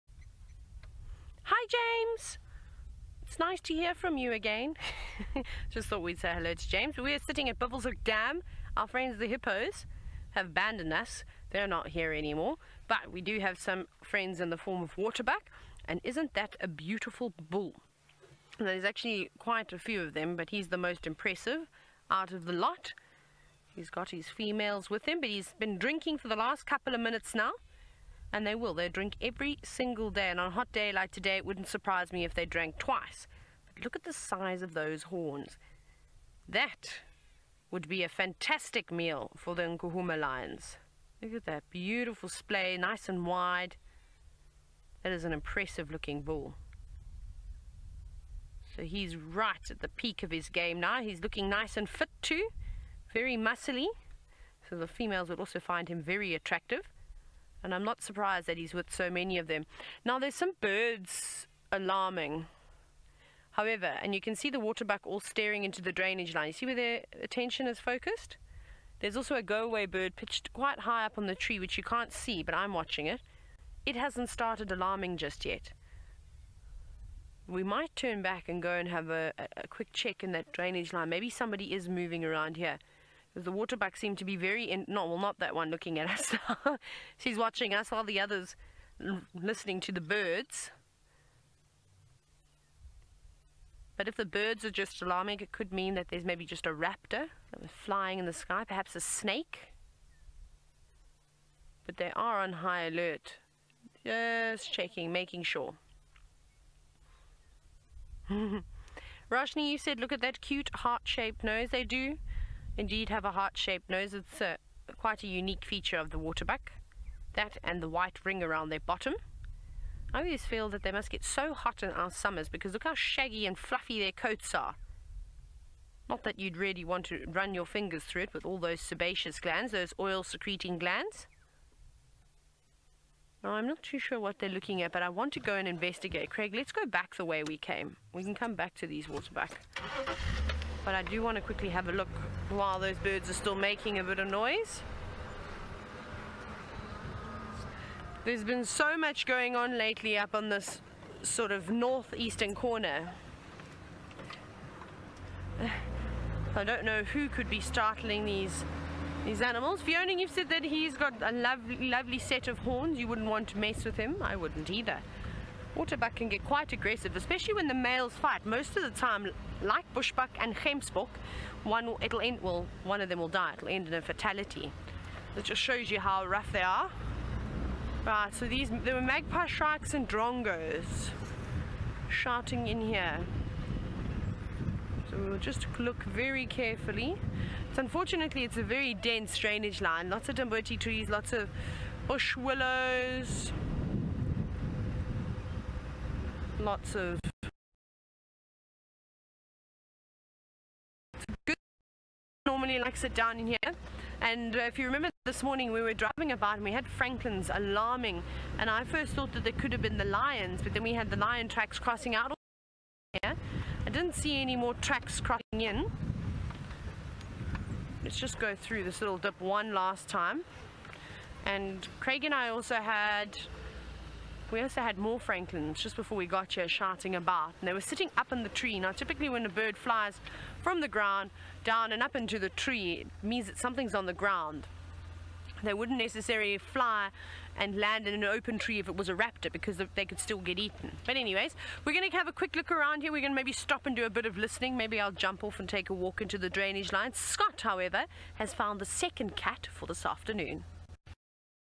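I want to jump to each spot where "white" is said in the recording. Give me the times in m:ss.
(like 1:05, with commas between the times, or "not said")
1:57.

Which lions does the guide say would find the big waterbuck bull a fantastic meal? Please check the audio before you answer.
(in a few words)
Nkuhuma lions.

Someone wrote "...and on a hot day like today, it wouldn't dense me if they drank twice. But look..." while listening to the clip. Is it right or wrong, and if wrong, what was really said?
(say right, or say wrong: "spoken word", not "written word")
wrong: "surprise", not "dense".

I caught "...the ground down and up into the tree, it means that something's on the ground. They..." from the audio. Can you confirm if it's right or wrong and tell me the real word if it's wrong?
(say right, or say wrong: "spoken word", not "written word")
right.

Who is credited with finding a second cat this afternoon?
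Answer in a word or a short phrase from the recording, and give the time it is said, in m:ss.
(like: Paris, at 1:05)
Scott, at 4:07.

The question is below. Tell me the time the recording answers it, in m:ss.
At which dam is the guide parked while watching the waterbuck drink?
0:07.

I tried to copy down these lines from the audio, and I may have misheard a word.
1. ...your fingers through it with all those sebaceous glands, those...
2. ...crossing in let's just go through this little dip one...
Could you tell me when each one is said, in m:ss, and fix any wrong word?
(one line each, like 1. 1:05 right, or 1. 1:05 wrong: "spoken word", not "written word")
1. 2:07 right
2. 3:35 right.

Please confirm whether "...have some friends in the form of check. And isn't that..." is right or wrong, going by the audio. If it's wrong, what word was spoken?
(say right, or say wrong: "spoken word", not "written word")
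wrong: "waterbuck", not "check".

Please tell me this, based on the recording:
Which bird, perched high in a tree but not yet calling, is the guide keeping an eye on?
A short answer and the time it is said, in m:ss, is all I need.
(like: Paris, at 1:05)
Go-away bird, at 1:09.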